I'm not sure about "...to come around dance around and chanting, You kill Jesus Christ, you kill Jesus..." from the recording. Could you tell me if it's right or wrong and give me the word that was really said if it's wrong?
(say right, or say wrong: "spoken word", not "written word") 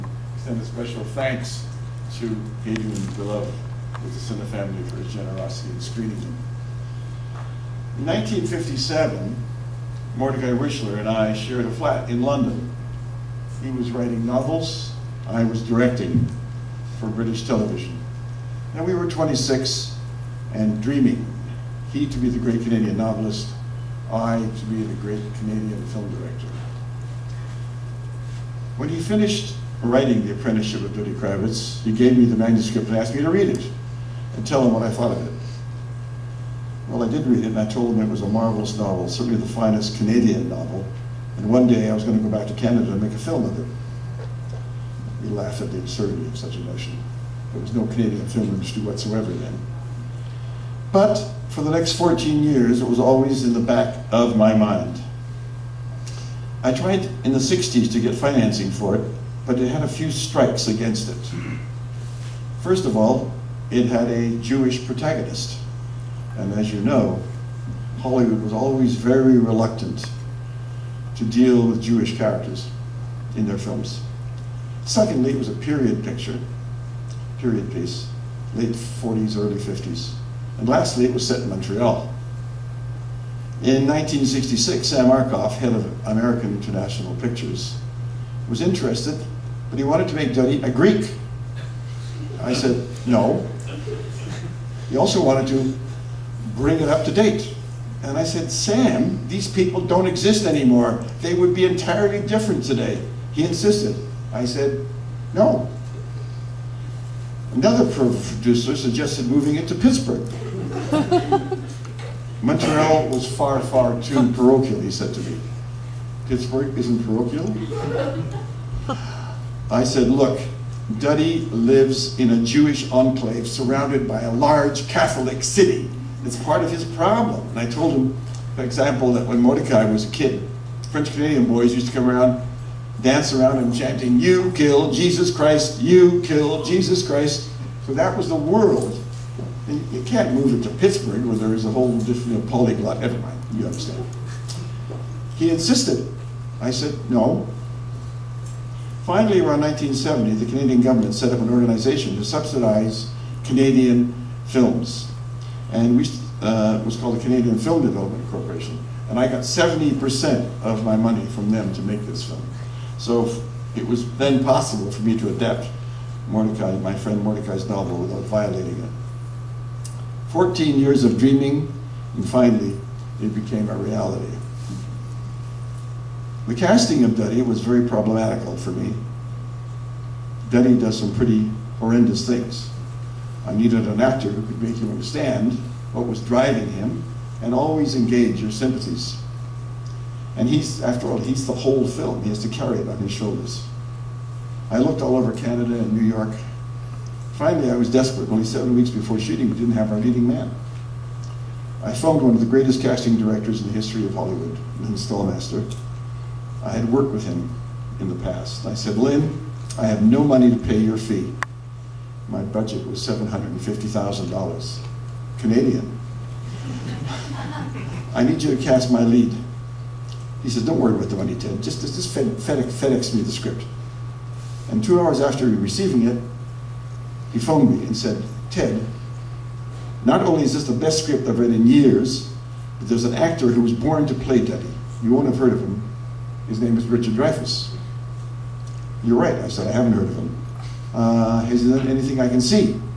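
right.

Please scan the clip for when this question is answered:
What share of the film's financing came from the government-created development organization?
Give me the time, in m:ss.
2:39.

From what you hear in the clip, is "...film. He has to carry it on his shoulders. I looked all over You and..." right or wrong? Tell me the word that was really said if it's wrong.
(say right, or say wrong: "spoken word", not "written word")
wrong: "Canada", not "You".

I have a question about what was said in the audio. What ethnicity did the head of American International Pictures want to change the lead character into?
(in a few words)
Greek.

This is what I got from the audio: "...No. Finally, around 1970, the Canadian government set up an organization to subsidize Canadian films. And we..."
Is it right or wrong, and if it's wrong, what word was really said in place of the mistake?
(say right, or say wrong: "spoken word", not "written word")
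right.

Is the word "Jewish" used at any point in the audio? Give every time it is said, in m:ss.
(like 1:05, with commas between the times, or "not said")
1:04, 1:11, 2:02.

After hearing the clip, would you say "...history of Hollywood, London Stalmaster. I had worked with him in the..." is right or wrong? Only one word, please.
wrong.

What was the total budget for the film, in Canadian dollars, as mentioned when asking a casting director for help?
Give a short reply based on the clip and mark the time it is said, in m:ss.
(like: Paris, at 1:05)
$750,000, at 3:33.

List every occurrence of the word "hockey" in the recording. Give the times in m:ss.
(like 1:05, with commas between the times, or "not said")
not said.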